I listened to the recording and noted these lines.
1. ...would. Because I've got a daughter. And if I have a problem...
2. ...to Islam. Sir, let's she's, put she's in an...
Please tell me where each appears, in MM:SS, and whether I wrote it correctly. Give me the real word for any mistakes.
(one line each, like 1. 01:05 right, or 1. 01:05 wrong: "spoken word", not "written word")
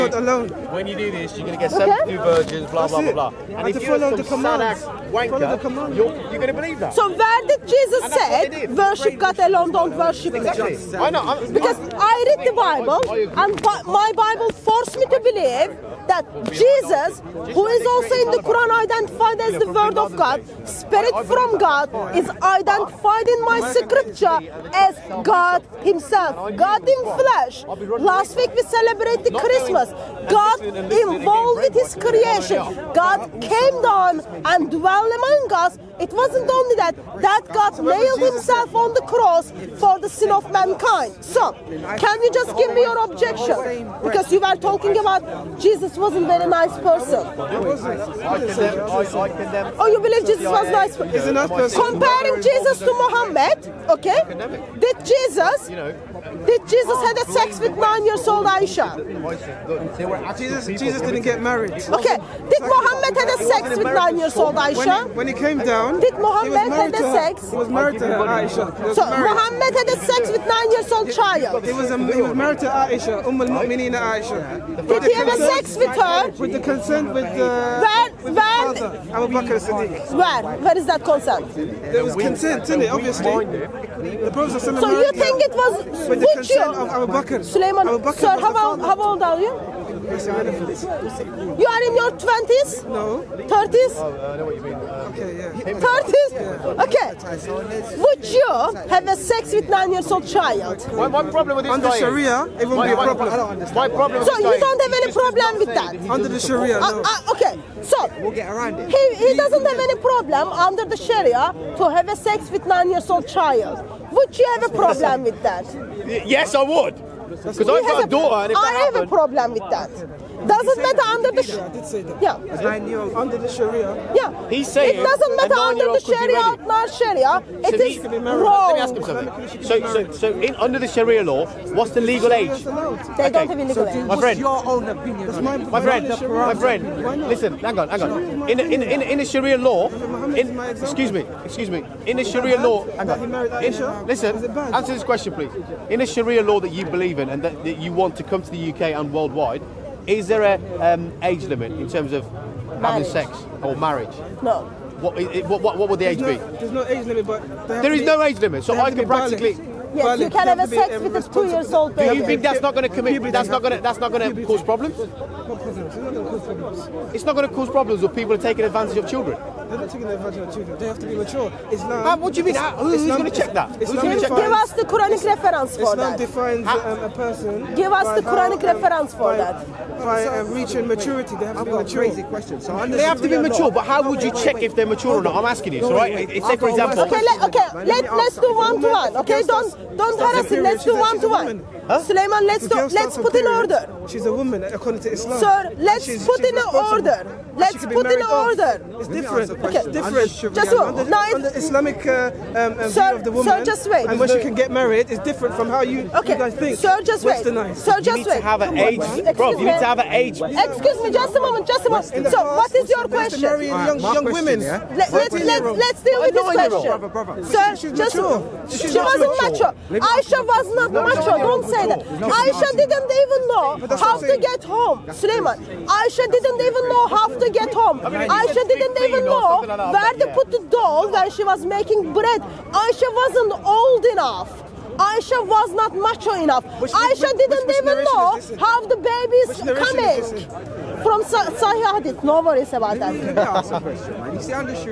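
1. 01:56 right
2. 03:15 right.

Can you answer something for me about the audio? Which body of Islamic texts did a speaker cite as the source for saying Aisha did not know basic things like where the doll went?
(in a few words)
Sahih Hadith.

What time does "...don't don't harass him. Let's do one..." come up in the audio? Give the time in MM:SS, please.
03:09.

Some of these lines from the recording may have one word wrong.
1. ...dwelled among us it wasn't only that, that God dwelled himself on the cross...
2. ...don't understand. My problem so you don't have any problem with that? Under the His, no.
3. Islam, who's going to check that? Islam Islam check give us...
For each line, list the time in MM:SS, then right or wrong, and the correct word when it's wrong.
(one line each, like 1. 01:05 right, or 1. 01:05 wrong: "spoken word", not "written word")
1. 00:34 wrong: "nailed", not "dwelled"
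2. 01:43 wrong: "Sharia", not "His"
3. 02:52 right.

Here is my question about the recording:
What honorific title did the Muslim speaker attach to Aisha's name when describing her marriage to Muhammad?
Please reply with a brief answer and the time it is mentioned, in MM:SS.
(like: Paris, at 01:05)
Umm al-Mu'mineen, at 01:13.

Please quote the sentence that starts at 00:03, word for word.
And, if you're some Sadak wanker, you're, you're going to believe that.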